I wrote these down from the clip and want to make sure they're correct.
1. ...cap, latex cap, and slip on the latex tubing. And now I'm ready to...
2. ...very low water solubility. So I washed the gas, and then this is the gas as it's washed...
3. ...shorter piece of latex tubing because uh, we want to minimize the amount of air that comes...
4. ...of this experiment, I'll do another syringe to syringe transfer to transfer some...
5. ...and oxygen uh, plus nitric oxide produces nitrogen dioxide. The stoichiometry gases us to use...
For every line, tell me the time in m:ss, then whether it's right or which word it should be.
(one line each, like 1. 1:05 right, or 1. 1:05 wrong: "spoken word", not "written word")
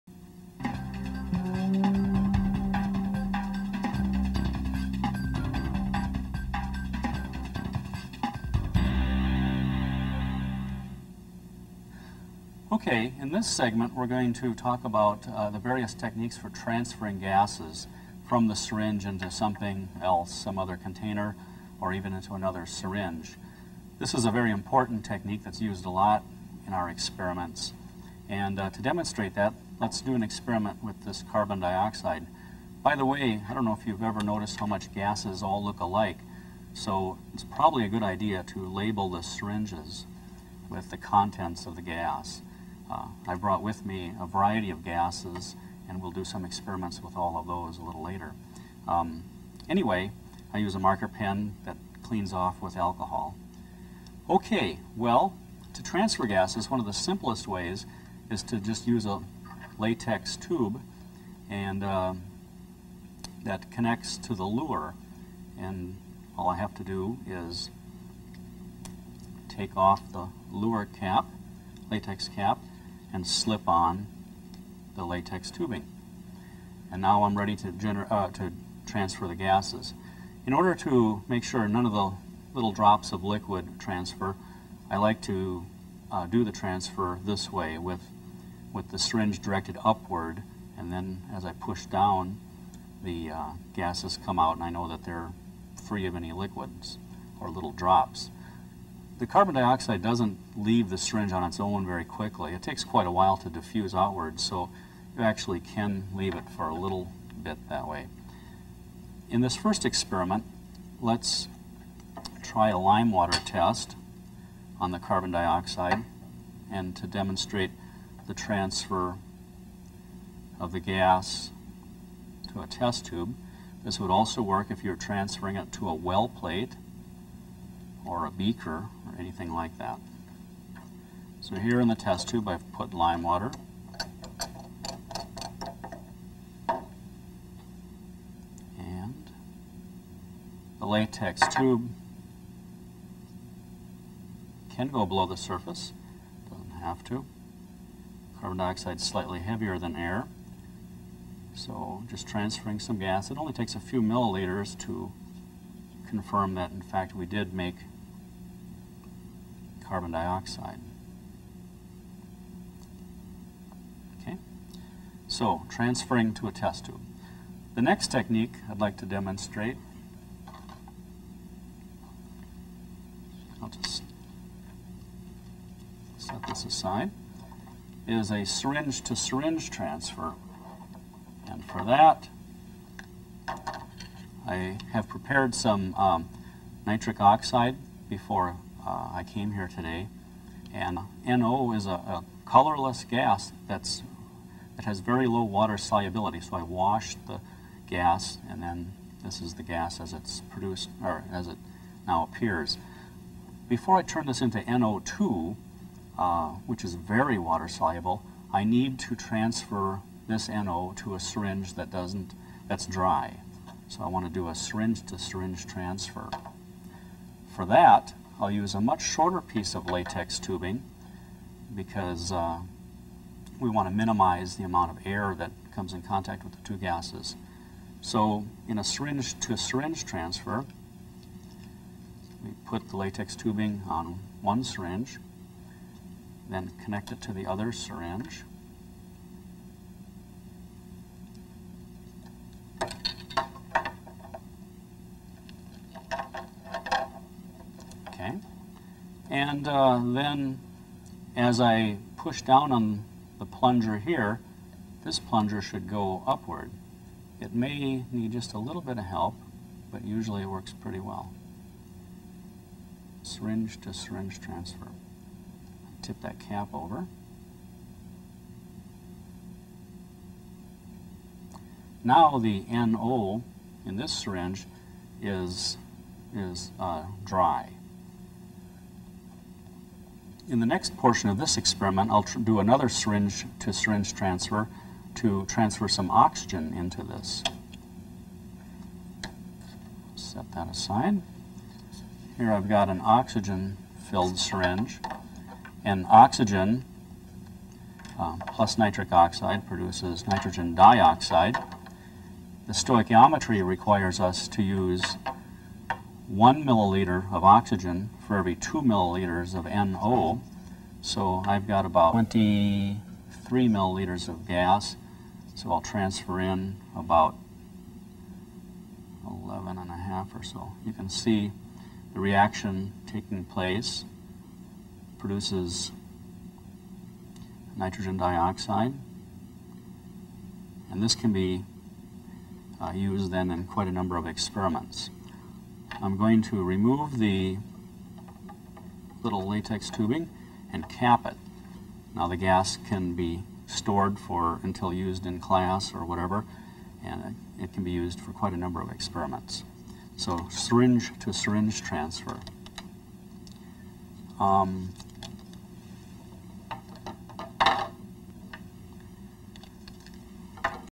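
1. 1:10 right
2. 3:14 wrong: "produced", not "washed"
3. 3:39 right
4. 4:41 right
5. 4:55 wrong: "requires", not "gases".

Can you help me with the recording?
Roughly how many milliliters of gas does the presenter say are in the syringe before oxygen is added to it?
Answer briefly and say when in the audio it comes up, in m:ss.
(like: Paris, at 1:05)
23, at 5:12.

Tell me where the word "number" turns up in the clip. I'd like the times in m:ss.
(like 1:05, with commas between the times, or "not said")
5:33, 5:48.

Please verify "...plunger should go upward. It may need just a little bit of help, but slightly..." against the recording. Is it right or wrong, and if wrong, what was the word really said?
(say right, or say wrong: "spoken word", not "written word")
wrong: "usually", not "slightly".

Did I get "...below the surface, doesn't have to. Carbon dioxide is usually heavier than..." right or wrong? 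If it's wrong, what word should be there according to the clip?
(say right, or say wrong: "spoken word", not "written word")
wrong: "slightly", not "usually".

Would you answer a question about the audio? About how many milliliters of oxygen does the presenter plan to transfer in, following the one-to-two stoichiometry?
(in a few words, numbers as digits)
11.5.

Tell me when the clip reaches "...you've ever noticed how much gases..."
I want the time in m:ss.
0:33.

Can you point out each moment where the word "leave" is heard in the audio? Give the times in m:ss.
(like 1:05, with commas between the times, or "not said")
1:40, 1:46.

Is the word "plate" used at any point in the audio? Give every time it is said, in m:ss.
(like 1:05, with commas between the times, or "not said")
2:06.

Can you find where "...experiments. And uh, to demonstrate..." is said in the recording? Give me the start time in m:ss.
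0:26.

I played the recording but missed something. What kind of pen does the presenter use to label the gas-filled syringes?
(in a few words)
Marker pen.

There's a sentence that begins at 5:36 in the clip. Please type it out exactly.
I'm going to remove the little latex tubing and cap it.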